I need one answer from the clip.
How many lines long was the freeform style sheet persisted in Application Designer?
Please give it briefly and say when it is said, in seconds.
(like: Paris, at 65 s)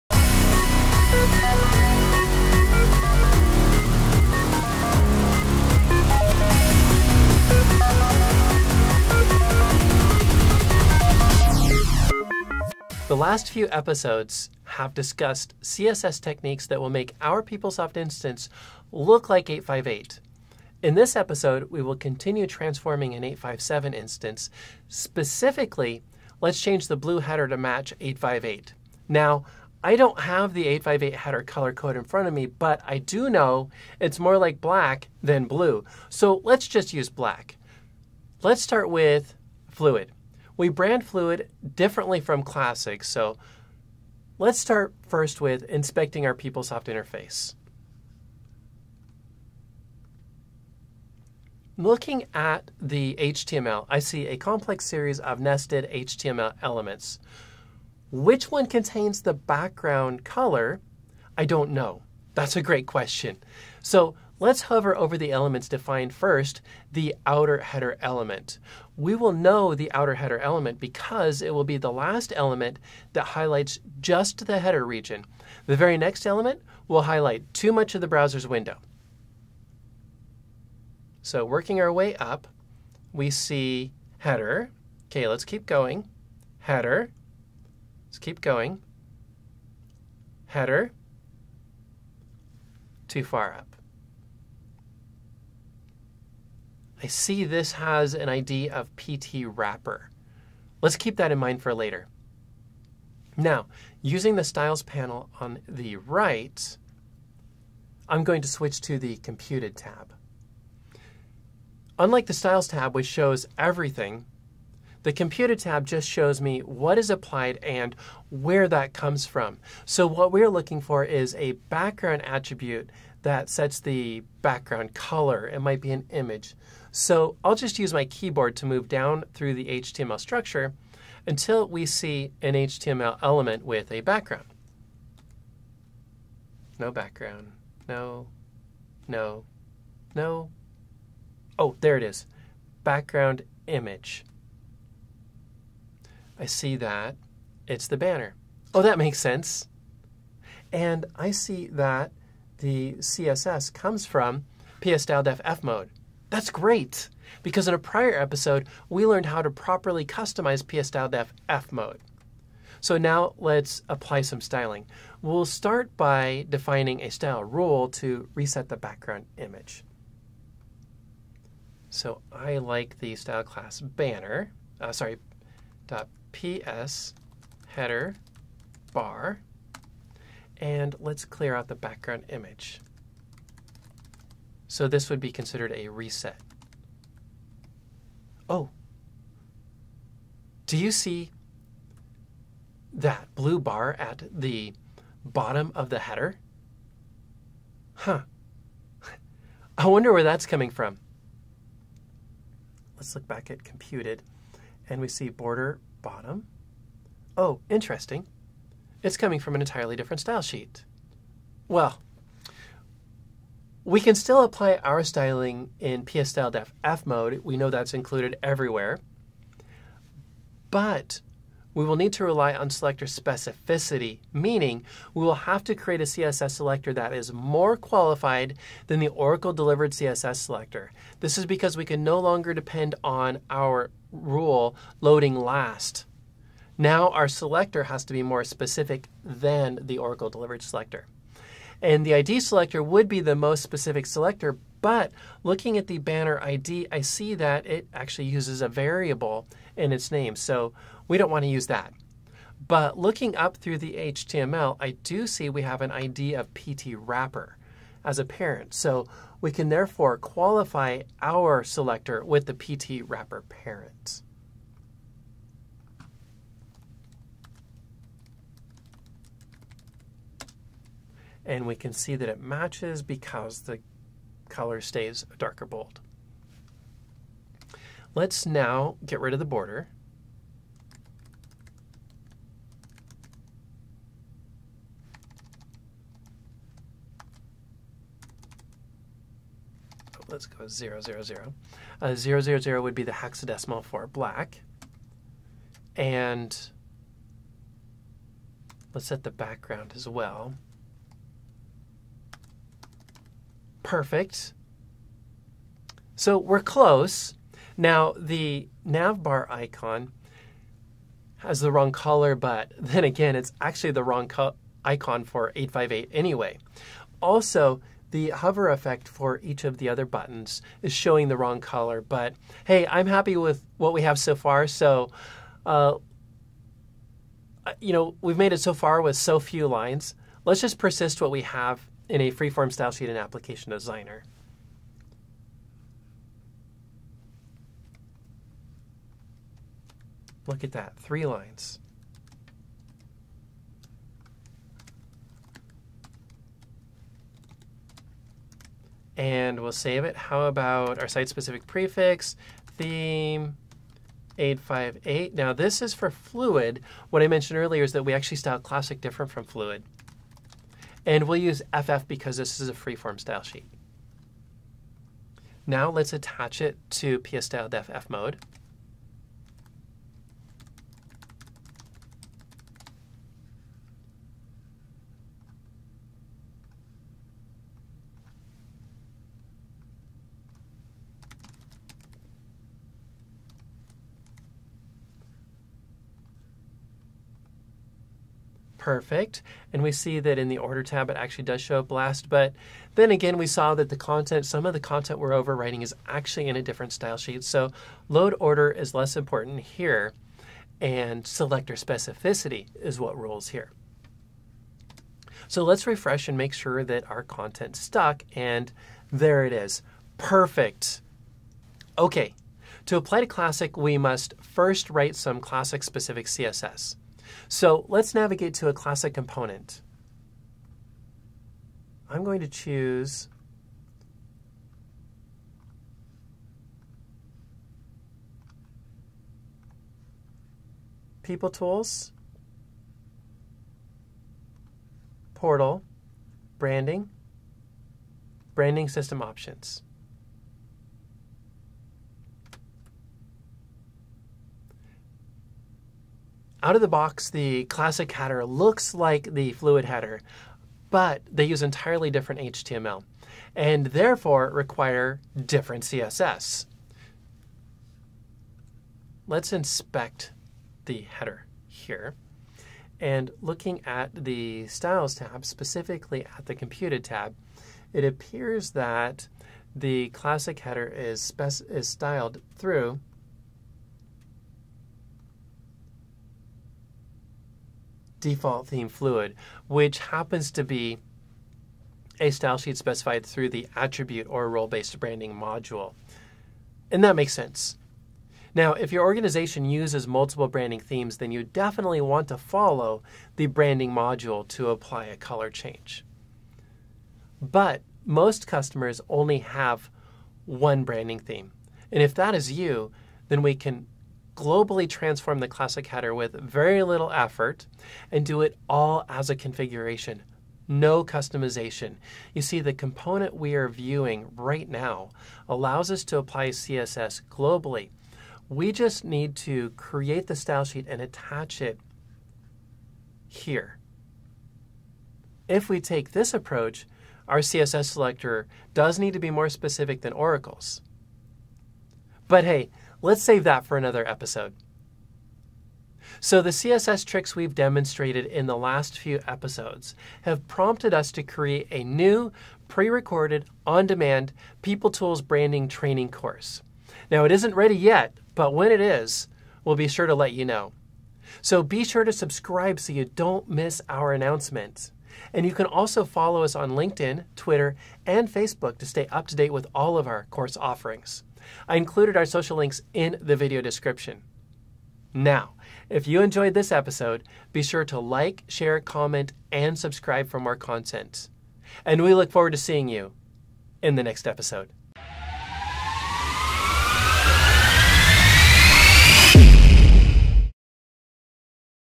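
3, at 340 s.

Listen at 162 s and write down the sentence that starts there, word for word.
So now let's apply some styling.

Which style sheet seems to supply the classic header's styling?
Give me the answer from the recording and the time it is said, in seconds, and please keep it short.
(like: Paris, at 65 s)
Default theme fluid, at 478 s.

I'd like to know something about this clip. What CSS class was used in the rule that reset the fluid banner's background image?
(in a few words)
PS header bar.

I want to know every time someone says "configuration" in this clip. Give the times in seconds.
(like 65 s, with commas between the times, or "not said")
509 s.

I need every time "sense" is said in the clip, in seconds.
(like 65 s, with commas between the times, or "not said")
149 s, 487 s.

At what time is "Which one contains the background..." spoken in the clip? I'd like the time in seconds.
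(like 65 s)
58 s.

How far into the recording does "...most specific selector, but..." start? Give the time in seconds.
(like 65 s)
243 s.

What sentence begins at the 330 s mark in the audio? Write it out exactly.
Let's just persist what we have in a freeform style sheet in application designer.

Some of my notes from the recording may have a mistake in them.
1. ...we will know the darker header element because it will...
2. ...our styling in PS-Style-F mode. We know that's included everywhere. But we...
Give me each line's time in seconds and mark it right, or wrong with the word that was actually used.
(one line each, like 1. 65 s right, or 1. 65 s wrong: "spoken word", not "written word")
1. 69 s wrong: "outer", not "darker"
2. 214 s right.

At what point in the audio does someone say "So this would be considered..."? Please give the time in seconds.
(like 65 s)
184 s.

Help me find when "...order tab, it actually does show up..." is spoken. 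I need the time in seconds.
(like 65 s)
390 s.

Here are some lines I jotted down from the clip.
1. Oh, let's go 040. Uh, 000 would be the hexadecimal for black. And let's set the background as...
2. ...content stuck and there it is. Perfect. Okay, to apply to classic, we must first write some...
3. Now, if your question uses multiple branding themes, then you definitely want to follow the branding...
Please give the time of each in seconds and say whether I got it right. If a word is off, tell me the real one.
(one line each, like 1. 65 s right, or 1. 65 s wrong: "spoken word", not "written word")
1. 290 s wrong: "000", not "040"
2. 407 s right
3. 488 s wrong: "organization", not "question".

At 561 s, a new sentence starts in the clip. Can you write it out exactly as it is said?
I included our social links in the video description.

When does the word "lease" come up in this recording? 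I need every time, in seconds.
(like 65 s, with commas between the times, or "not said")
not said.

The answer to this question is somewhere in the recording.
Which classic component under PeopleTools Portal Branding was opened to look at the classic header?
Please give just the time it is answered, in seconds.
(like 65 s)
438 s.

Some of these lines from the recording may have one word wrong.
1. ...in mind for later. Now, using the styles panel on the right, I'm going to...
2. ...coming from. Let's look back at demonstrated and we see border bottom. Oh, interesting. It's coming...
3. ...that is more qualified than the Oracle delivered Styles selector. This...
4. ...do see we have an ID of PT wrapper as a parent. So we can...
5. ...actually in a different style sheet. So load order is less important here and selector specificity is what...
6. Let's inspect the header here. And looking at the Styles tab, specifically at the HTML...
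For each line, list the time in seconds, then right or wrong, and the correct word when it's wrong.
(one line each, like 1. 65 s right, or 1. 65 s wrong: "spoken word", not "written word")
1. 101 s right
2. 200 s wrong: "computed", not "demonstrated"
3. 226 s wrong: "CSS", not "Styles"
4. 254 s right
5. 396 s right
6. 459 s wrong: "Computed", not "HTML".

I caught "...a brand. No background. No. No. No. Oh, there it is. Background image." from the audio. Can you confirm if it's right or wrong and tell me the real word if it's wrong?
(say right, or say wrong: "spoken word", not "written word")
wrong: "background", not "brand".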